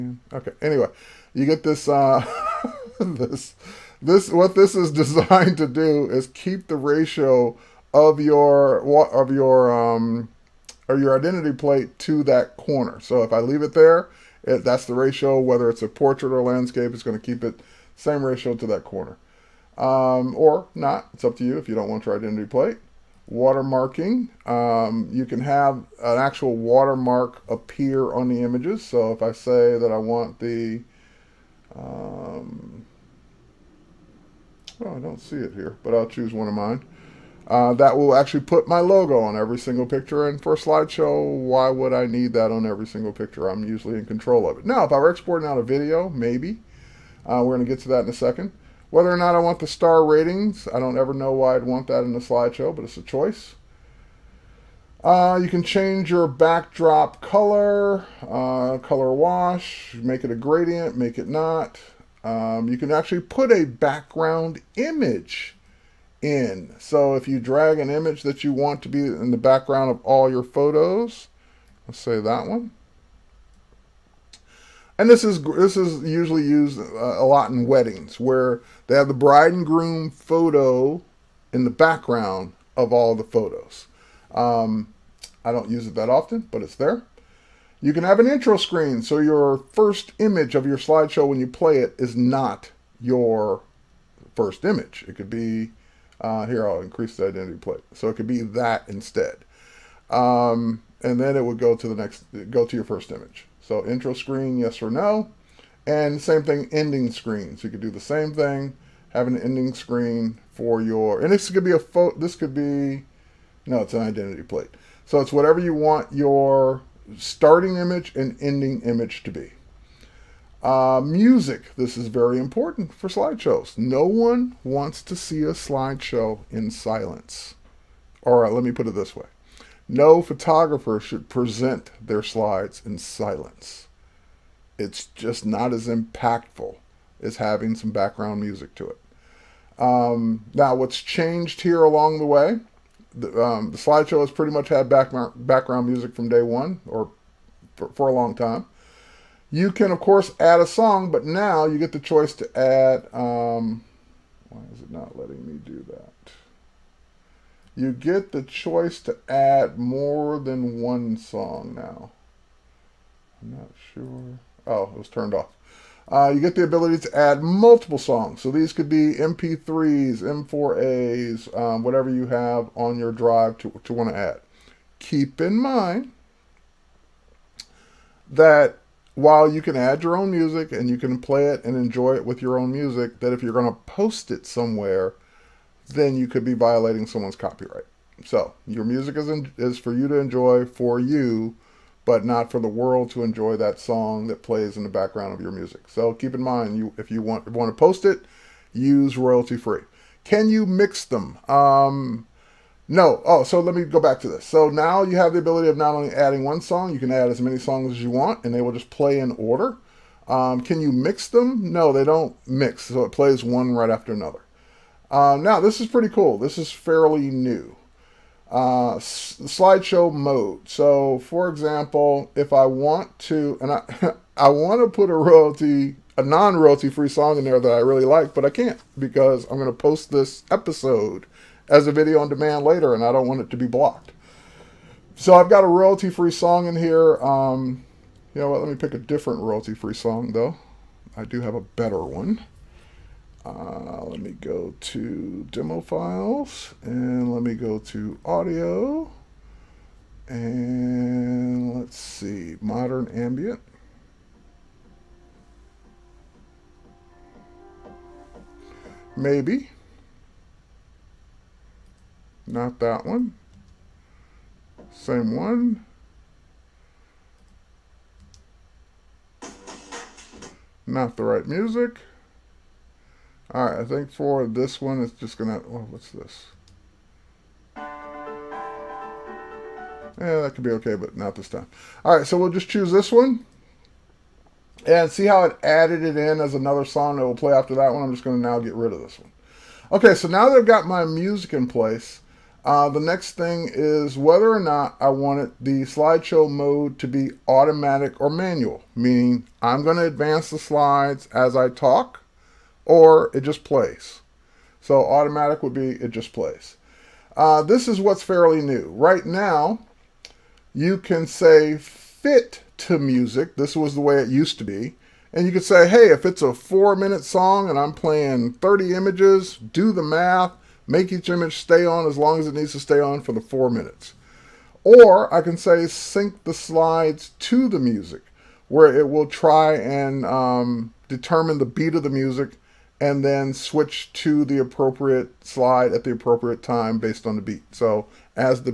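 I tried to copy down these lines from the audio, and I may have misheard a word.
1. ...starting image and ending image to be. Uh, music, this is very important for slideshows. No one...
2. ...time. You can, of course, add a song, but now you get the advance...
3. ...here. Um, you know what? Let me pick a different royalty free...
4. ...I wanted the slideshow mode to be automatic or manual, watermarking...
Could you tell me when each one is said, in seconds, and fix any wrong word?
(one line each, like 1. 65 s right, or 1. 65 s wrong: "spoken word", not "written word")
1. 117 s right
2. 148 s wrong: "choice", not "advance"
3. 236 s right
4. 295 s wrong: "meaning", not "watermarking".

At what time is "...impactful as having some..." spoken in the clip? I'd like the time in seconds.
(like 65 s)
135 s.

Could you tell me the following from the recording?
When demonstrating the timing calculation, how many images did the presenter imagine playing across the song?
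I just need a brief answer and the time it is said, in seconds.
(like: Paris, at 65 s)
30, at 318 s.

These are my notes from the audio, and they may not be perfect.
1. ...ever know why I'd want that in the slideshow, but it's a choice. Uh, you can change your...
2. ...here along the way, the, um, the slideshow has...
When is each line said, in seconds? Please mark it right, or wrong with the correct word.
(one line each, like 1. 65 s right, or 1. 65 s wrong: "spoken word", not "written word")
1. 50 s right
2. 141 s right.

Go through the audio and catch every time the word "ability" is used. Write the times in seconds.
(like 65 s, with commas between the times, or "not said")
166 s, 205 s.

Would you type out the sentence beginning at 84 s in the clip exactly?
Um, I don't use it that often, but it's there.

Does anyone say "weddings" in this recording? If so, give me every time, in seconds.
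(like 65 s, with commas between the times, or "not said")
77 s.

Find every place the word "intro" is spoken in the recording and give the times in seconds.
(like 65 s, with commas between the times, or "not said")
88 s, 103 s.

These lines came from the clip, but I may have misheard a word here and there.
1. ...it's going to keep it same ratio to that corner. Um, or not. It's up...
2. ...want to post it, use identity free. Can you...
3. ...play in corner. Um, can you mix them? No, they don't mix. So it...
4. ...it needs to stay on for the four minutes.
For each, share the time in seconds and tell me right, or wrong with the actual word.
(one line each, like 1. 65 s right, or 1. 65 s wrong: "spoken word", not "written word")
1. 16 s right
2. 197 s wrong: "royalty", not "identity"
3. 208 s wrong: "order", not "corner"
4. 322 s right.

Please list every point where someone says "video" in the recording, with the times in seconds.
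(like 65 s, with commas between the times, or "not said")
45 s, 231 s.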